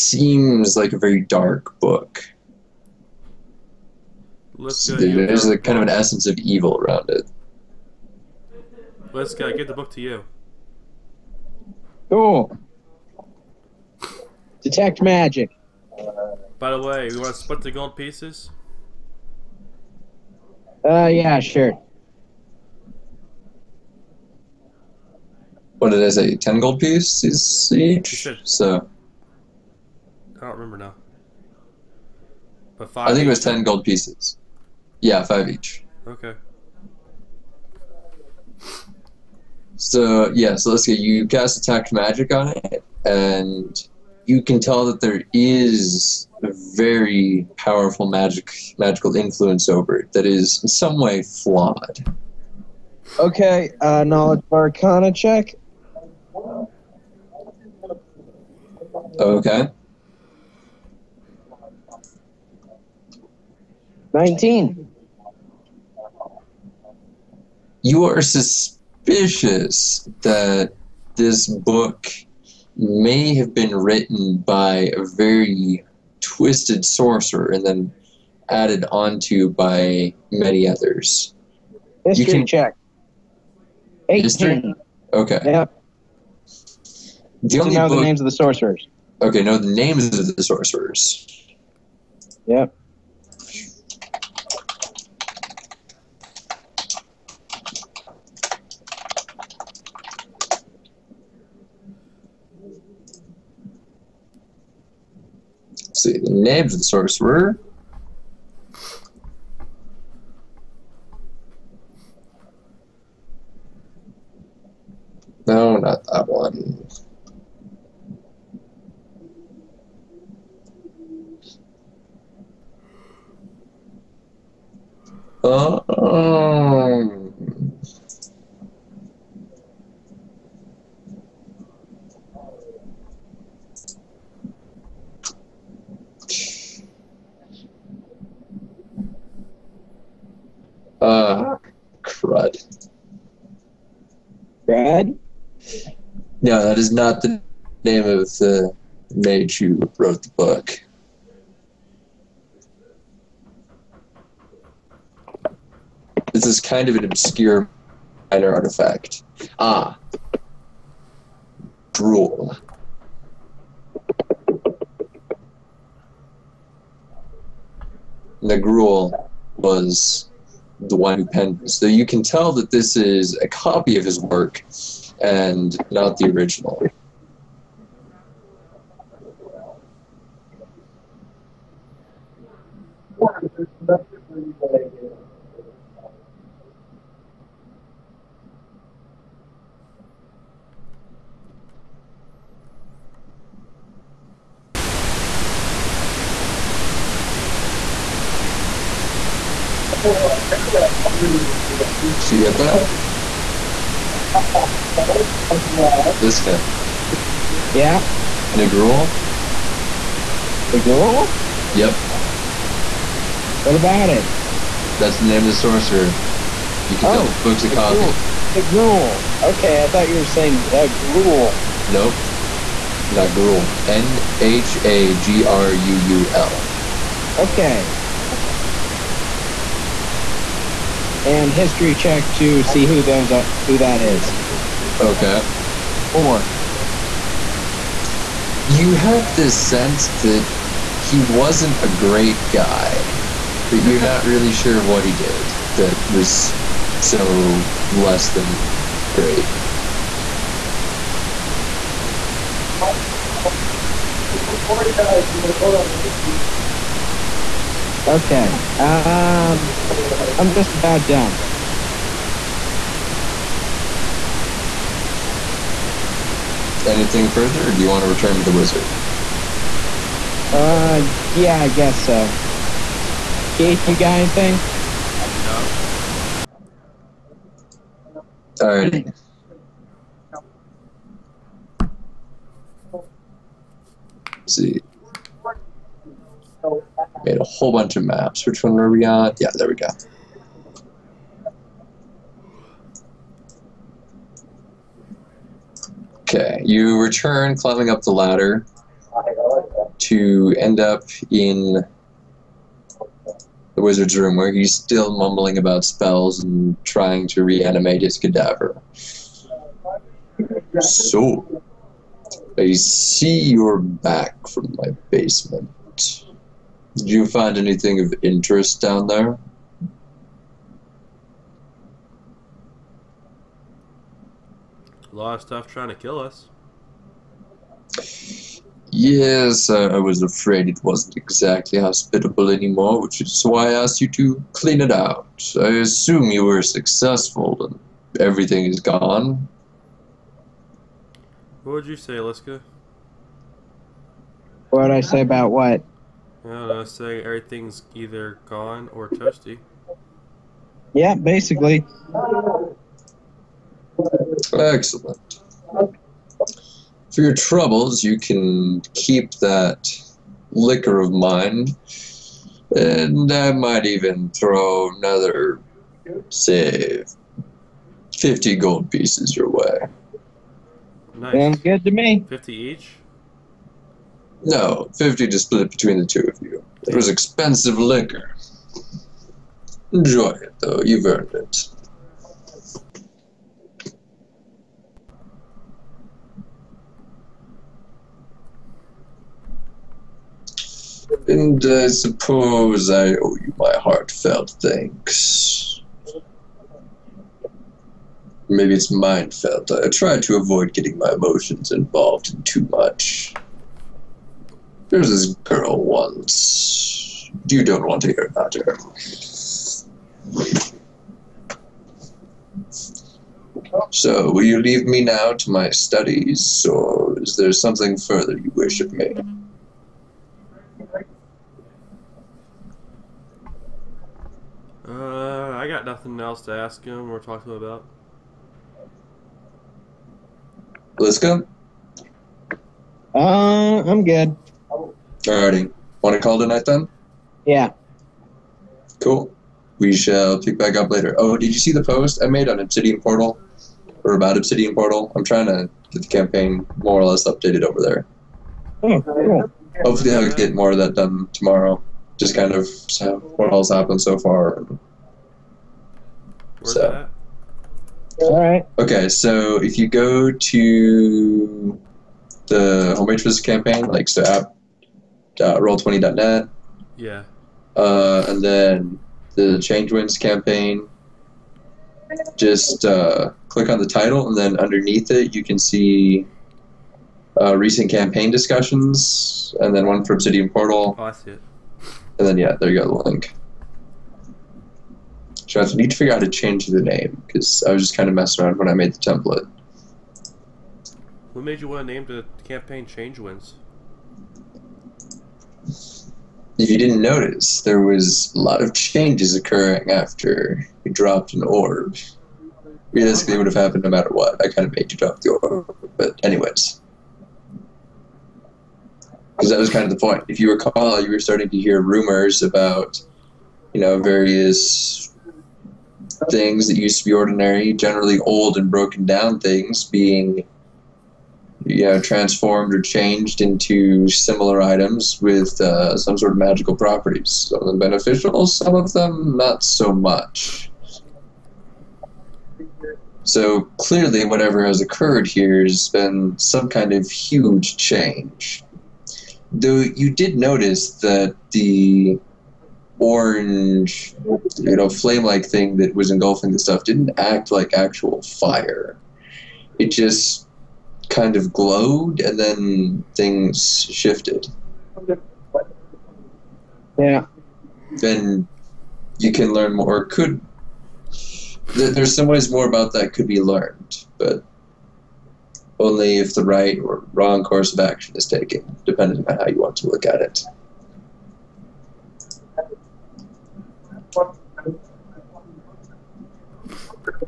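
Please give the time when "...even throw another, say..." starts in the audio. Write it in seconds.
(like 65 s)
363 s.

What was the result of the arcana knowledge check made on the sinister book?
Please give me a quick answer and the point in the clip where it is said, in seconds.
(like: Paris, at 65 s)
19, at 64 s.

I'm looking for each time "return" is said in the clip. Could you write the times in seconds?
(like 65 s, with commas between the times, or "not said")
268 s, 296 s.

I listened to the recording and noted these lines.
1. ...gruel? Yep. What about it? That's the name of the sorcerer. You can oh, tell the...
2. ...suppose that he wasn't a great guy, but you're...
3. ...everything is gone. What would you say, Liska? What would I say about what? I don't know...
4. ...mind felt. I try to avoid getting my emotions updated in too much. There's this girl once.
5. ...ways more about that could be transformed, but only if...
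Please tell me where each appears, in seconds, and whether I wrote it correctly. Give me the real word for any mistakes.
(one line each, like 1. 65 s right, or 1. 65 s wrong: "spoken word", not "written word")
1. 210 s right
2. 239 s wrong: "sense", not "suppose"
3. 338 s right
4. 398 s wrong: "involved", not "updated"
5. 562 s wrong: "learned", not "transformed".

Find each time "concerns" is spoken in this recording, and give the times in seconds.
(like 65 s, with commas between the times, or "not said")
not said.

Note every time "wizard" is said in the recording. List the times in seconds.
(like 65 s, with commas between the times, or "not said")
268 s, 303 s.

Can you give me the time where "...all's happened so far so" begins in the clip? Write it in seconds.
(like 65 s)
453 s.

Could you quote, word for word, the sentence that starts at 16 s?
By the way, we want to split the gold pieces?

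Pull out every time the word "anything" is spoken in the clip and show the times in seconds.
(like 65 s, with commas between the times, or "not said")
266 s, 274 s, 317 s.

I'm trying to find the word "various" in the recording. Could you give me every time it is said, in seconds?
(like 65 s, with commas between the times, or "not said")
514 s.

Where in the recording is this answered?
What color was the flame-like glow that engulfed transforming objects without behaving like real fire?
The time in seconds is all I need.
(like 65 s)
543 s.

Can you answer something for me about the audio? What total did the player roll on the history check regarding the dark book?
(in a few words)
18.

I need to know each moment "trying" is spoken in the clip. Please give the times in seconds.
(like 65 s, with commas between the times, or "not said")
306 s, 325 s, 445 s.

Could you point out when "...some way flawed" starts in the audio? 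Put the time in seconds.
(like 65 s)
50 s.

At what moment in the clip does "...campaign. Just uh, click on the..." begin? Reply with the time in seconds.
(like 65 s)
470 s.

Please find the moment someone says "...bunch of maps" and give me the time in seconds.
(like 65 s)
287 s.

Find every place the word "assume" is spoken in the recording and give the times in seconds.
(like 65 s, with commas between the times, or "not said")
335 s.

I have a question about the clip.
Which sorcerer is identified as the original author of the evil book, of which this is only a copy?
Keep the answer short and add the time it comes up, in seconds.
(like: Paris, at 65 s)
Nhagruul, at 168 s.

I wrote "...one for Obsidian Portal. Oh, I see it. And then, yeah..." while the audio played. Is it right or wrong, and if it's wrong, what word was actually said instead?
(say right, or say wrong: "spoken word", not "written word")
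right.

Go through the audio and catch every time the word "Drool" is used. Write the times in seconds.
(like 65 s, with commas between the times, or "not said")
161 s.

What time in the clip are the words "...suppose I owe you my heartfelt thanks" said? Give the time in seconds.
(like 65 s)
391 s.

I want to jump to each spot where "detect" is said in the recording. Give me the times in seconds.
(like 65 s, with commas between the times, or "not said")
14 s, 41 s.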